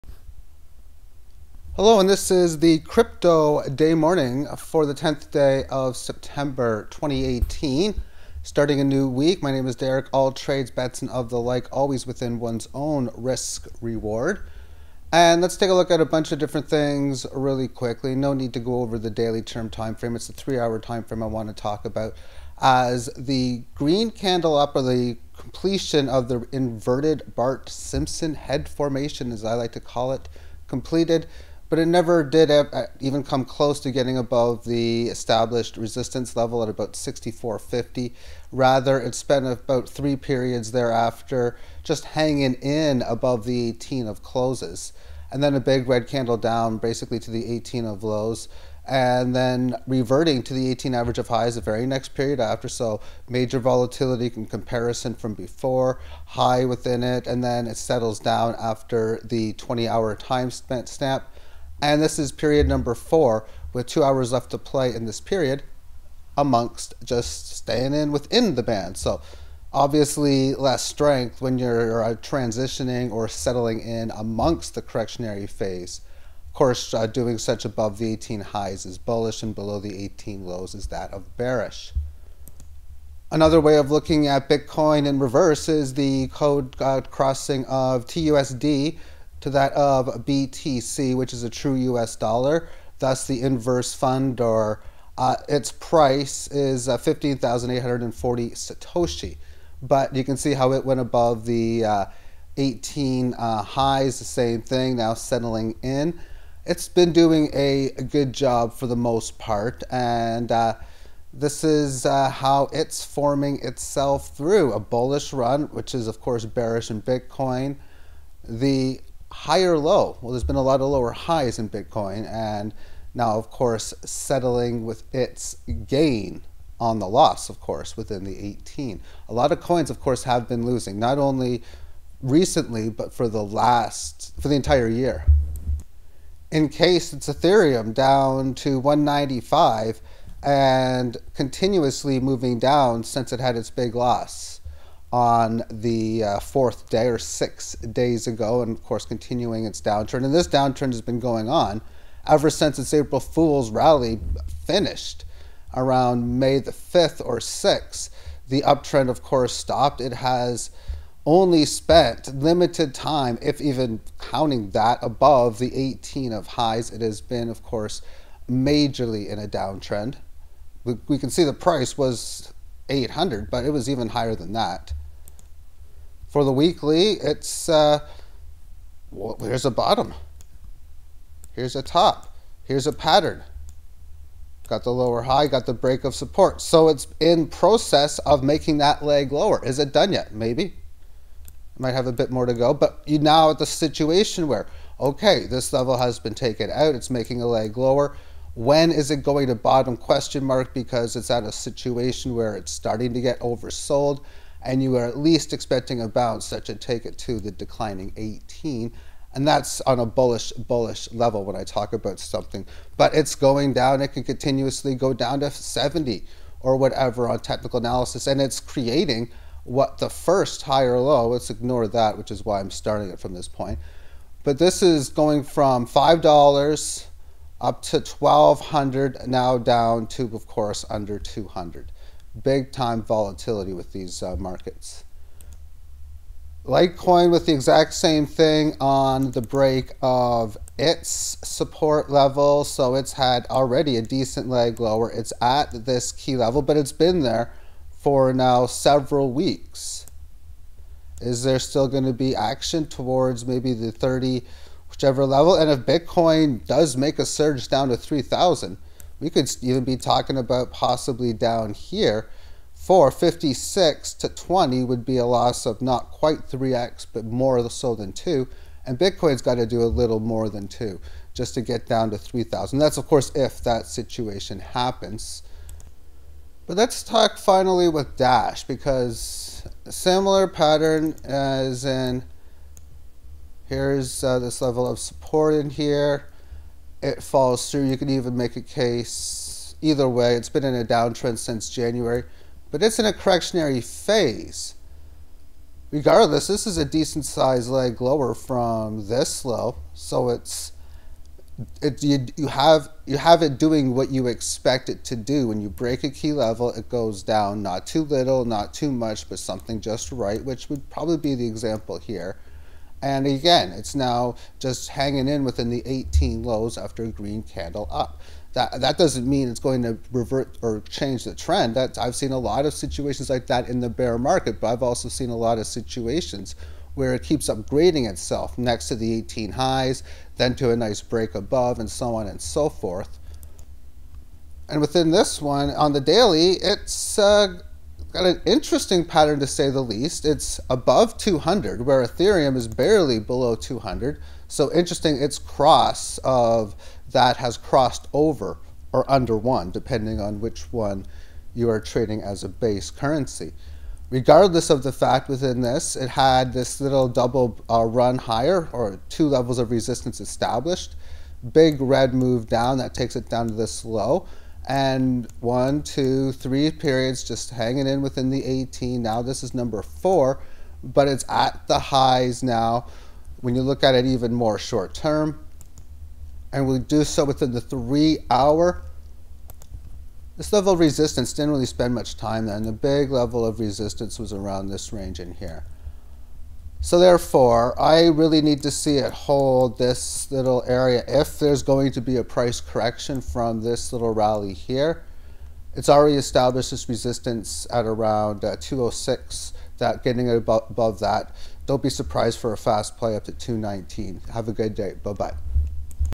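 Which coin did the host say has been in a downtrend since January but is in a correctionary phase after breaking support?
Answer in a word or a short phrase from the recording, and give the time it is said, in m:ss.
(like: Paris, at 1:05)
Dash, at 4:38.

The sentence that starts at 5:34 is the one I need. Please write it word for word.
And within this one, on the daily, it's uh, got an interesting pattern to say the least.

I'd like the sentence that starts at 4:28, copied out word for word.
And Bitcoin's got to do a little more than 2 just to get down to 3,000.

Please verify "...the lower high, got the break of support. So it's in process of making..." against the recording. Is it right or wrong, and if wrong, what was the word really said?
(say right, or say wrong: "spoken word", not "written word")
right.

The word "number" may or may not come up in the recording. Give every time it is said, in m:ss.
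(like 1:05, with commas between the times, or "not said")
1:02, 6:09.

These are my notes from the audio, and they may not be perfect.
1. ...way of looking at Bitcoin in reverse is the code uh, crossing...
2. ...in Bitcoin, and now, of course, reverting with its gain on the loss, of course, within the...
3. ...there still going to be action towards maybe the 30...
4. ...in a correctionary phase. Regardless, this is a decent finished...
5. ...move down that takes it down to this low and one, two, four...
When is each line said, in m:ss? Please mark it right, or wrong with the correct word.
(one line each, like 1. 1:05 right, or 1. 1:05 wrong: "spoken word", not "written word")
1. 1:23 right
2. 2:01 wrong: "settling", not "reverting"
3. 4:11 right
4. 4:52 wrong: "sized", not "finished"
5. 6:02 wrong: "three", not "four".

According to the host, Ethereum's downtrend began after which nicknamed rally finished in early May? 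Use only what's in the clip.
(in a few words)
April Fool's rally.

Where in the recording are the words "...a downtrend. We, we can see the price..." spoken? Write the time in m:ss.
2:49.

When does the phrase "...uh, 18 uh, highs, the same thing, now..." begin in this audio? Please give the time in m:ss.
1:41.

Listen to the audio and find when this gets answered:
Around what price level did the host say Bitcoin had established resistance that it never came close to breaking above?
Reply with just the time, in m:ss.
0:36.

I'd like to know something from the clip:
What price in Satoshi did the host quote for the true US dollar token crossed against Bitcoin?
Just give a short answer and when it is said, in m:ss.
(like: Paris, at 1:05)
15,840 Satoshi, at 1:36.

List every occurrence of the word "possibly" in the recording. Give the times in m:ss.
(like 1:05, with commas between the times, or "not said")
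4:20.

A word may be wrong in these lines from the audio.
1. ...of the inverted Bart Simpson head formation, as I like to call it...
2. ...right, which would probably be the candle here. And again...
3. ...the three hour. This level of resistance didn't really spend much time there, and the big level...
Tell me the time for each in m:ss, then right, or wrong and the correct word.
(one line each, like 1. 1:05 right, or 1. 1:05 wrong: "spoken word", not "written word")
1. 0:26 right
2. 5:10 wrong: "example", not "candle"
3. 6:17 right.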